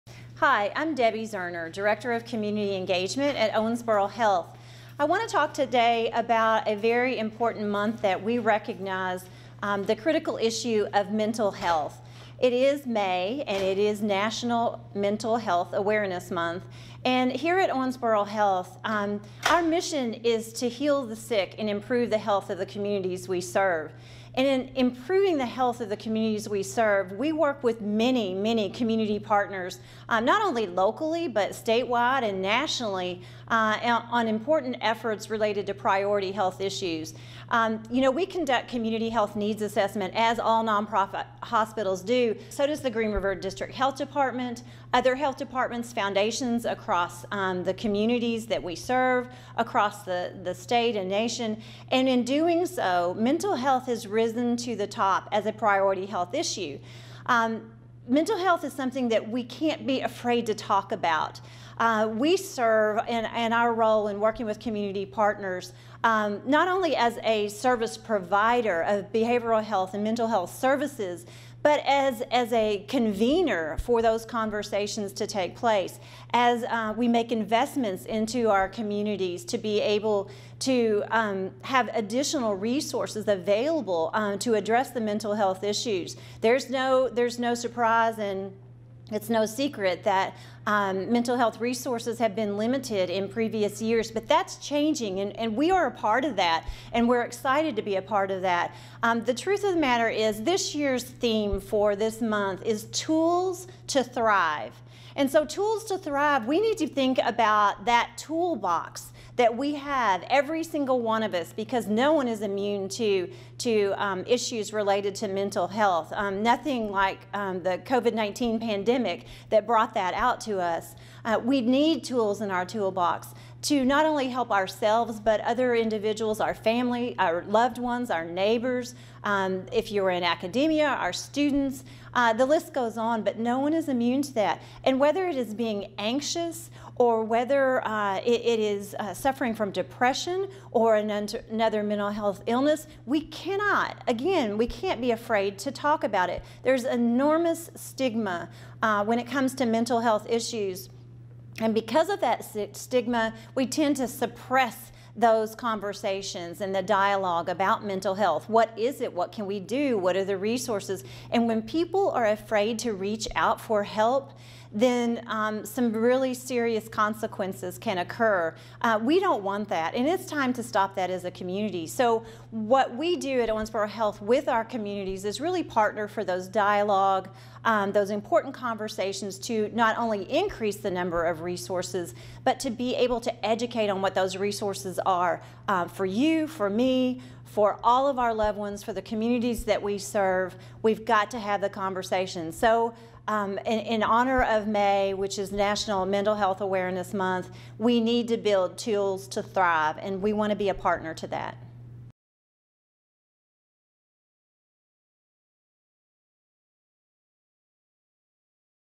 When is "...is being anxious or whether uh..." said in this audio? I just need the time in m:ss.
2:15.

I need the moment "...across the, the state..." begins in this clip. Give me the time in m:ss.
0:49.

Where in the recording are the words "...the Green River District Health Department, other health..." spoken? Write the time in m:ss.
0:42.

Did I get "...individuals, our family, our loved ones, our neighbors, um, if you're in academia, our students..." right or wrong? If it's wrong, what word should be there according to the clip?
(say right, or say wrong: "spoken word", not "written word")
right.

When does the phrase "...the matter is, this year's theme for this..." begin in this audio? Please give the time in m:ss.
1:39.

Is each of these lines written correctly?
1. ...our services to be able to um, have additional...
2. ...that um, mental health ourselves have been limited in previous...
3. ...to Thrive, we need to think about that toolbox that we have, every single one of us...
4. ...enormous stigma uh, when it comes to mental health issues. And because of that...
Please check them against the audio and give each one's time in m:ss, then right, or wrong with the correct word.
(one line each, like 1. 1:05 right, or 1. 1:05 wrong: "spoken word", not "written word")
1. 1:18 wrong: "communities", not "services"
2. 1:30 wrong: "resources", not "ourselves"
3. 1:45 right
4. 2:26 right.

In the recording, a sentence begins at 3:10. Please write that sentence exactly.
We've got to have the conversation.